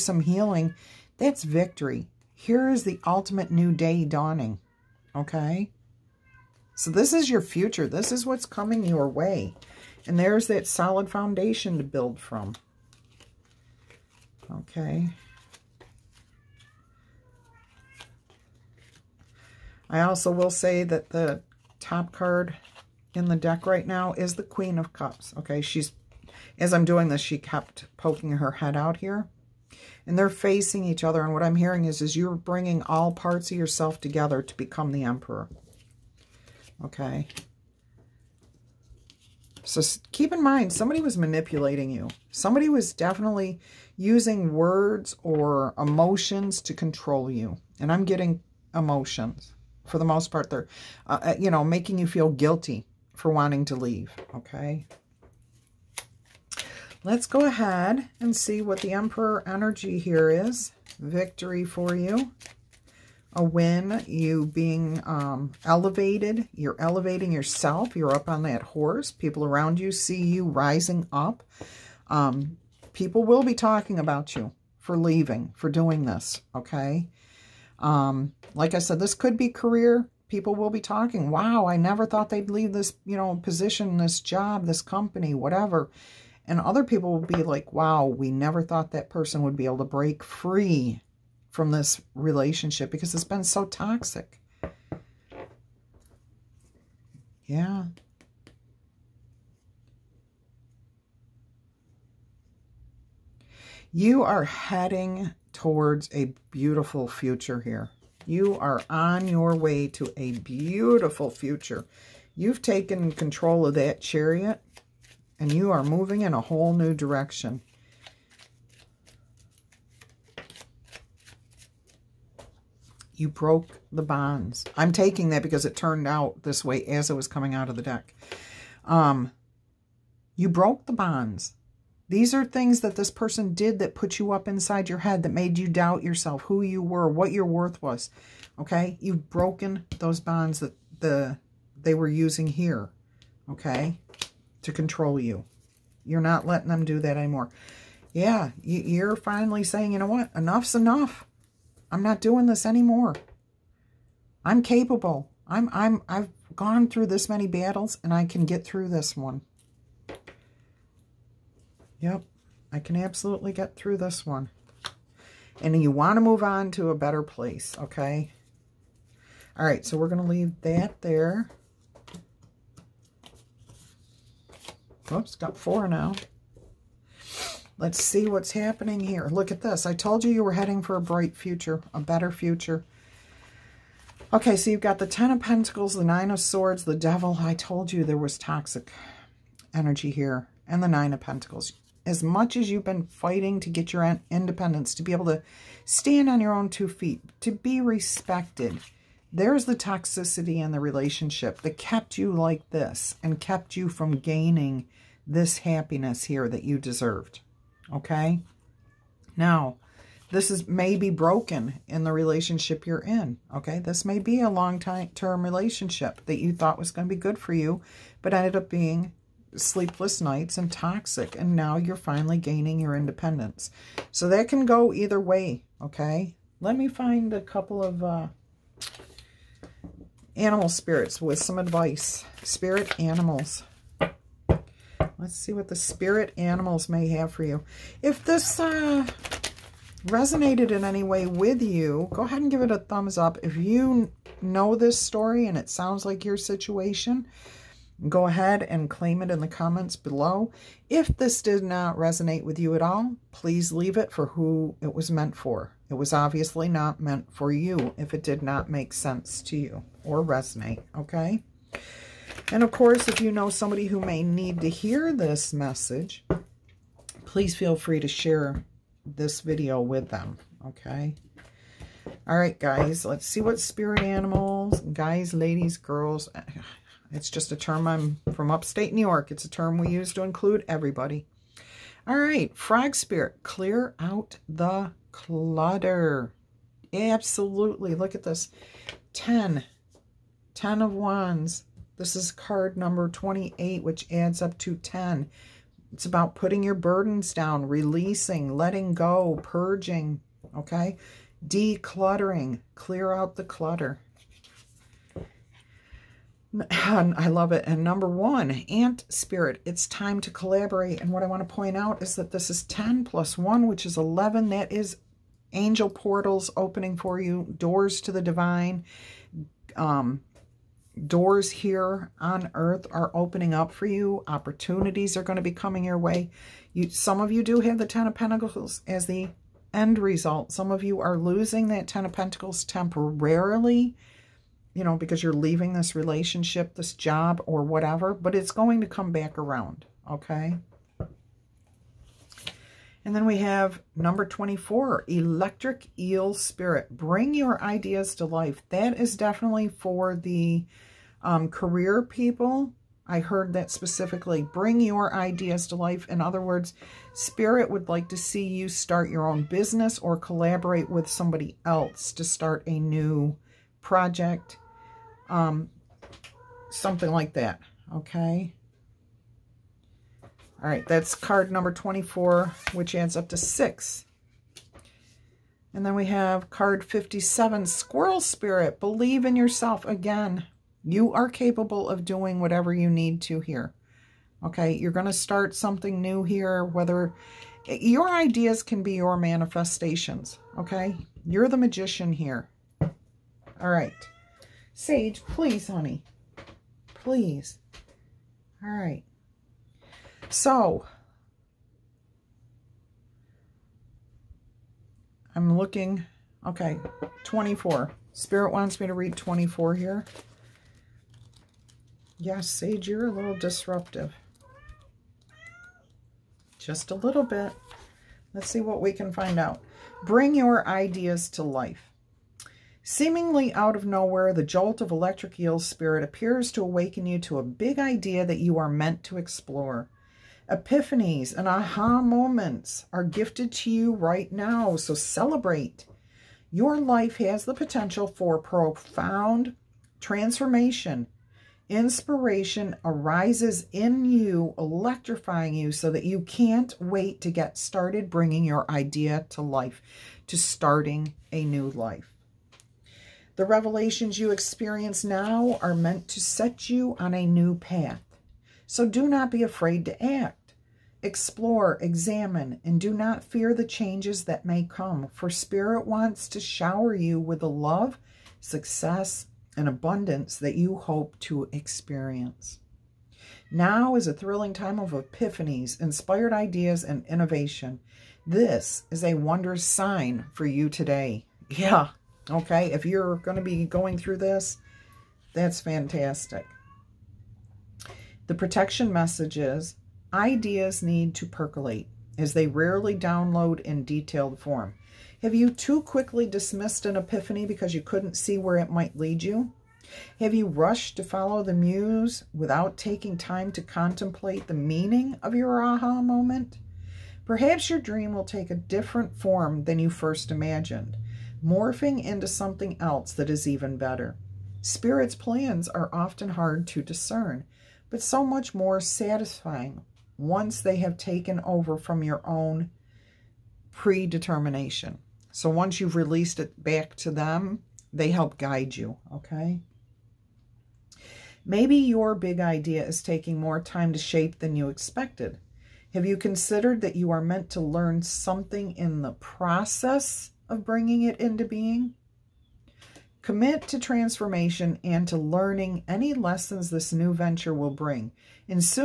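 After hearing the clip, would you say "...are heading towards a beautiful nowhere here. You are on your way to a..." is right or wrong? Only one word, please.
wrong.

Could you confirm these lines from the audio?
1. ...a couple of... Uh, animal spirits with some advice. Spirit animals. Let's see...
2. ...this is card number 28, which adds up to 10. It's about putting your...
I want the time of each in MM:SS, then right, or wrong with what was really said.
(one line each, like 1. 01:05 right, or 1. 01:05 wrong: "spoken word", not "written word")
1. 03:47 right
2. 04:51 right.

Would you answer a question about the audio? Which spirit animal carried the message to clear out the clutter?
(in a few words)
Frog.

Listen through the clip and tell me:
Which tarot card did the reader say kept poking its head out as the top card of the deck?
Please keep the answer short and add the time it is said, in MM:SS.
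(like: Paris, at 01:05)
Queen of Cups, at 00:24.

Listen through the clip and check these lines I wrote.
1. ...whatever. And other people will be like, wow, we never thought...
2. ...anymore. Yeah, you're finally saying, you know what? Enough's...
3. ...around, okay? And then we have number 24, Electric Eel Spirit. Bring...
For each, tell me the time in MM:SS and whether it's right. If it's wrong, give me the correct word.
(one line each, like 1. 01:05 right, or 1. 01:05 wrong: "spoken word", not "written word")
1. 01:25 right
2. 02:27 right
3. 05:39 right.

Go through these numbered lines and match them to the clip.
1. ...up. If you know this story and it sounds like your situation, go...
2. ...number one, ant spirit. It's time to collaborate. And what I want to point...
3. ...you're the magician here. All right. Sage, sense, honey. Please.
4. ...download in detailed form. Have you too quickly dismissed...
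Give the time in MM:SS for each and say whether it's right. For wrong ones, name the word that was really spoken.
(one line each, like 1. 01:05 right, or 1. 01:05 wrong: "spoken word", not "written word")
1. 04:03 right
2. 05:07 right
3. 06:31 wrong: "please", not "sense"
4. 08:12 right.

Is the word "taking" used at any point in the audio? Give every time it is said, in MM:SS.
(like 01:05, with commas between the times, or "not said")
02:04, 08:22, 08:53.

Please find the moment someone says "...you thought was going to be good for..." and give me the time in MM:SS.
03:36.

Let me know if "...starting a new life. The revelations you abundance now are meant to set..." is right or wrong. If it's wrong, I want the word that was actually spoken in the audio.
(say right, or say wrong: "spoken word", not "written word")
wrong: "experience", not "abundance".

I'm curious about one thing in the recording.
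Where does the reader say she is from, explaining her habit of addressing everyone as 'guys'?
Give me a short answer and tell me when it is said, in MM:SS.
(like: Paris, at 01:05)
Upstate New York, at 04:38.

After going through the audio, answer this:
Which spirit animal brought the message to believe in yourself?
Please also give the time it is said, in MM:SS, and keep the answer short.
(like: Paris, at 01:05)
Squirrel, at 06:17.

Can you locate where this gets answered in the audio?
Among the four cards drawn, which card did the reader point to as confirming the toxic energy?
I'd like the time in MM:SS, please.
03:06.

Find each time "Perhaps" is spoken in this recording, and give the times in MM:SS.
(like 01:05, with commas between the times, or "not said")
08:27.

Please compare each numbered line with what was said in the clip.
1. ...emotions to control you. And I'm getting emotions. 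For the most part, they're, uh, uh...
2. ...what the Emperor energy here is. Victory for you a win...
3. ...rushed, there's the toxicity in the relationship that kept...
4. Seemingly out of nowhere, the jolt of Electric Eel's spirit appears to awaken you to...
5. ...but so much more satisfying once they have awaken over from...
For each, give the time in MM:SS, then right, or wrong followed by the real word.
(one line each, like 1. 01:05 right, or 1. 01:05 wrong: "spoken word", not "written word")
1. 00:45 right
2. 00:58 right
3. 03:17 wrong: "respected", not "rushed"
4. 07:02 right
5. 08:37 wrong: "taken", not "awaken".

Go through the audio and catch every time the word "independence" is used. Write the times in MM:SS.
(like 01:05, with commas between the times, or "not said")
03:14, 03:42.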